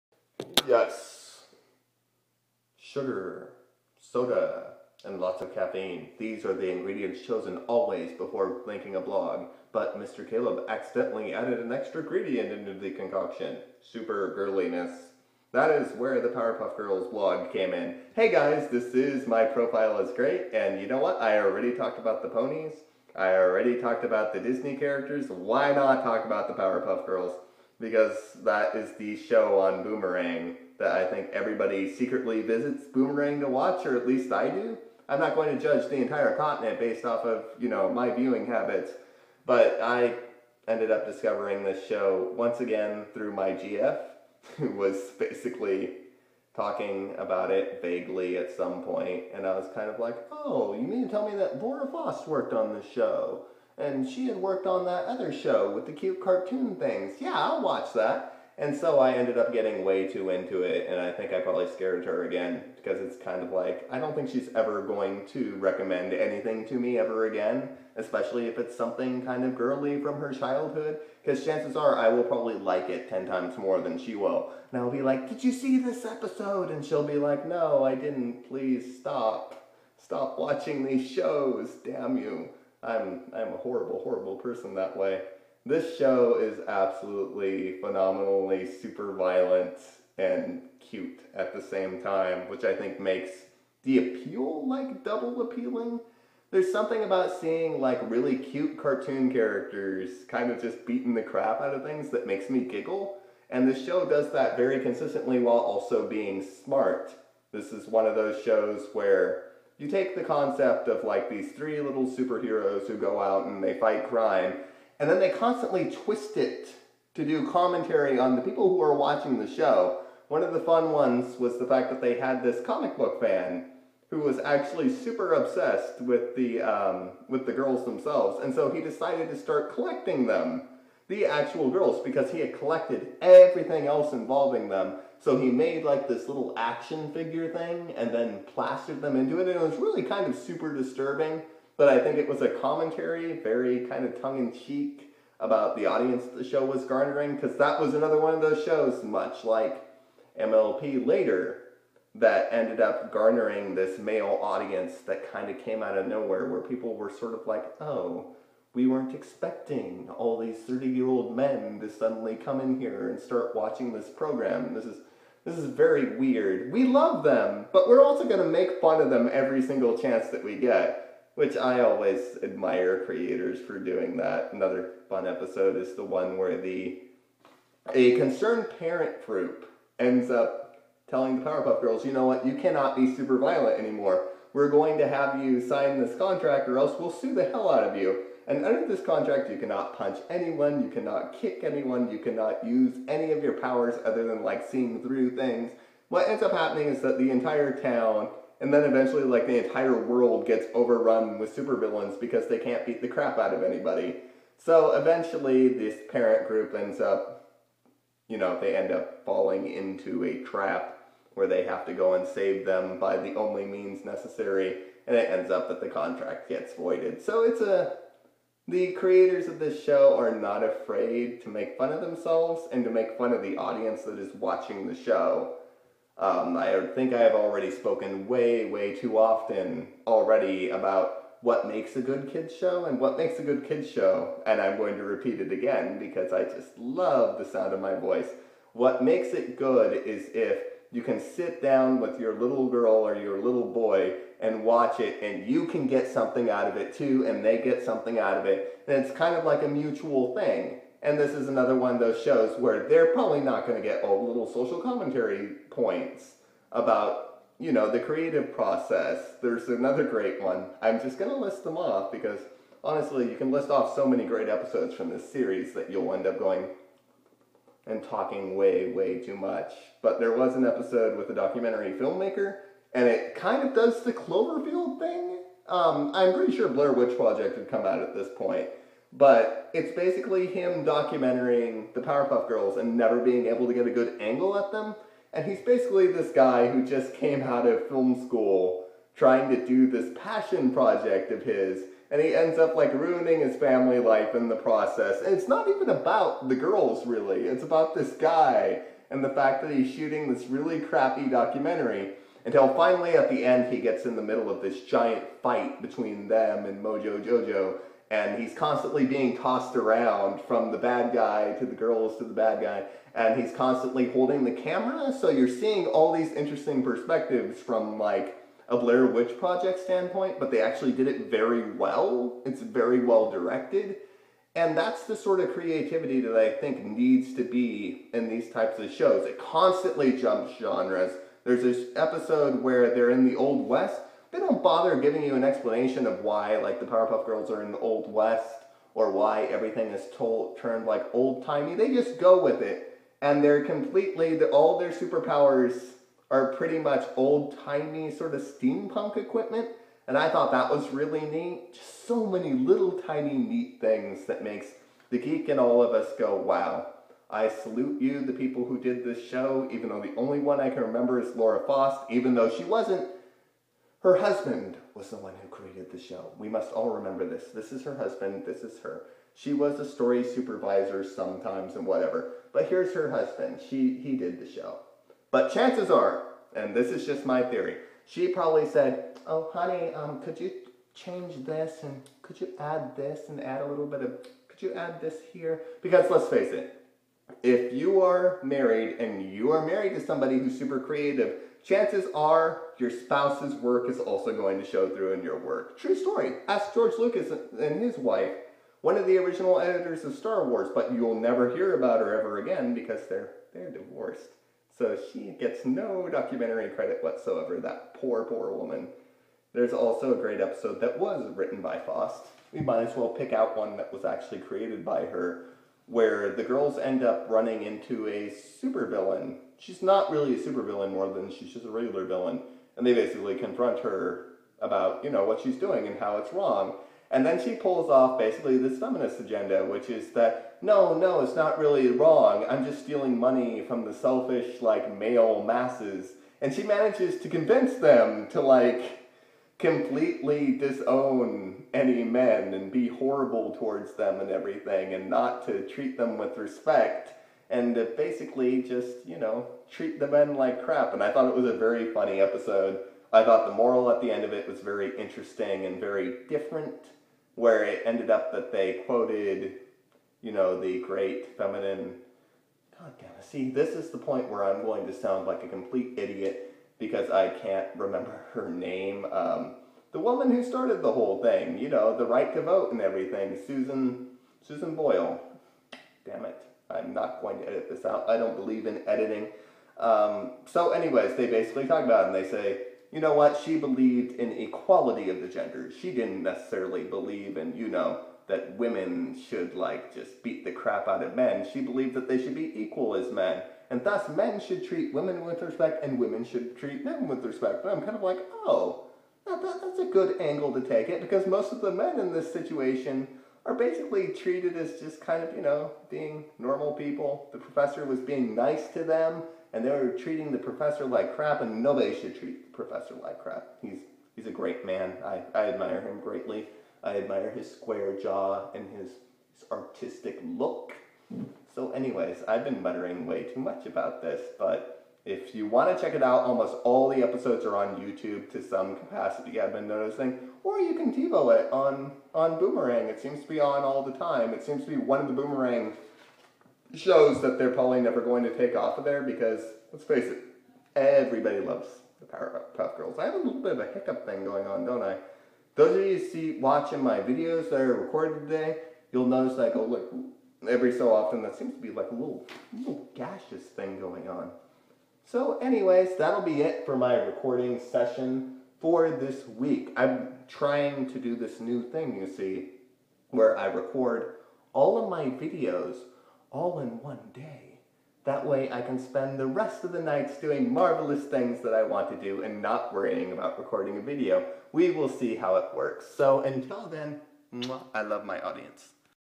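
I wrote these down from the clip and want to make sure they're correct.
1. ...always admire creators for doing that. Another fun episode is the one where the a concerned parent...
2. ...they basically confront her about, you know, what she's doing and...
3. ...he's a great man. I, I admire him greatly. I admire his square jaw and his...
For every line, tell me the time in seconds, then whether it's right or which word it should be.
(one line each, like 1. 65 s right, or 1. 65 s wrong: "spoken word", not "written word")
1. 171 s right
2. 422 s right
3. 514 s right.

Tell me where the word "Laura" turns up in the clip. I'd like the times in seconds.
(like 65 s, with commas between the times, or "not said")
51 s, 361 s.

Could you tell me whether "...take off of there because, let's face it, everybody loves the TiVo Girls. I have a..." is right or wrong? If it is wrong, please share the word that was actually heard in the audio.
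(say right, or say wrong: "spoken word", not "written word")
wrong: "Powerpuff", not "TiVo".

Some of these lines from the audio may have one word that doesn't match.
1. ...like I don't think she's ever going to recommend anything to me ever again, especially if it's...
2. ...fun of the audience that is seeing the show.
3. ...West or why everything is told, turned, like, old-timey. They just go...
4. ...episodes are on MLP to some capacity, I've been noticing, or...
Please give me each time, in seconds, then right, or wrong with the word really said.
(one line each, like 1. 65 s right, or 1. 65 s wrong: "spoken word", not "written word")
1. 63 s right
2. 223 s wrong: "watching", not "seeing"
3. 338 s right
4. 527 s wrong: "YouTube", not "MLP".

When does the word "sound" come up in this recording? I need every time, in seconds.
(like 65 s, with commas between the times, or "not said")
237 s, 464 s.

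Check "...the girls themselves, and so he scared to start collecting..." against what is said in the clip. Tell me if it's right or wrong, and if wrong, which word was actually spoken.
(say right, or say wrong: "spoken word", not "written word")
wrong: "decided", not "scared".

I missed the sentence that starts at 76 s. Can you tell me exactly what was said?
And she'll be like, No, I didn't.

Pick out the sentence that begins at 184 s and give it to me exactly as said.
We're going to have you sign this contract or else we'll sue the hell out of you.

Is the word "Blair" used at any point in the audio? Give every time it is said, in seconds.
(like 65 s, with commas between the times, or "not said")
276 s, 318 s.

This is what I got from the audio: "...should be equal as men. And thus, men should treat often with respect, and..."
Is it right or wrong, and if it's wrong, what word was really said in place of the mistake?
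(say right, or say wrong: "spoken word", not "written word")
wrong: "women", not "often".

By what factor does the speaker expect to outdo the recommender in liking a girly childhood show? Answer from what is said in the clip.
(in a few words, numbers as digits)
10.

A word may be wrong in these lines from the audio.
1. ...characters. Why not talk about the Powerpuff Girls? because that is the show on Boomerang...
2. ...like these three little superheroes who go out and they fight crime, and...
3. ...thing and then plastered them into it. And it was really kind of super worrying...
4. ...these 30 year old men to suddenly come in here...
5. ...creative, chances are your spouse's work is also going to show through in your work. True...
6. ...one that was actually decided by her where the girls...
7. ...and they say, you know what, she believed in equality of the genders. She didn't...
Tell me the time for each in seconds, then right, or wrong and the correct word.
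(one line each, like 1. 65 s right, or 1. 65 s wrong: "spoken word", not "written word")
1. 24 s right
2. 111 s right
3. 137 s wrong: "disturbing", not "worrying"
4. 160 s right
5. 390 s right
6. 413 s wrong: "created", not "decided"
7. 482 s right.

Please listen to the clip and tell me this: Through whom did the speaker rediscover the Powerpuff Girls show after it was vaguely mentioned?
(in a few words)
GF.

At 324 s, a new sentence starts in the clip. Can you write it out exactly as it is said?
And that's the sort of creativity that I think needs to be in these types of shows.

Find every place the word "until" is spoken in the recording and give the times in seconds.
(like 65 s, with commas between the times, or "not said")
302 s, 576 s.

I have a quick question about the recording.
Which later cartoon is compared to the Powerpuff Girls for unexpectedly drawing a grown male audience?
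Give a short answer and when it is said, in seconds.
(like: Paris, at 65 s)
MLP, at 150 s.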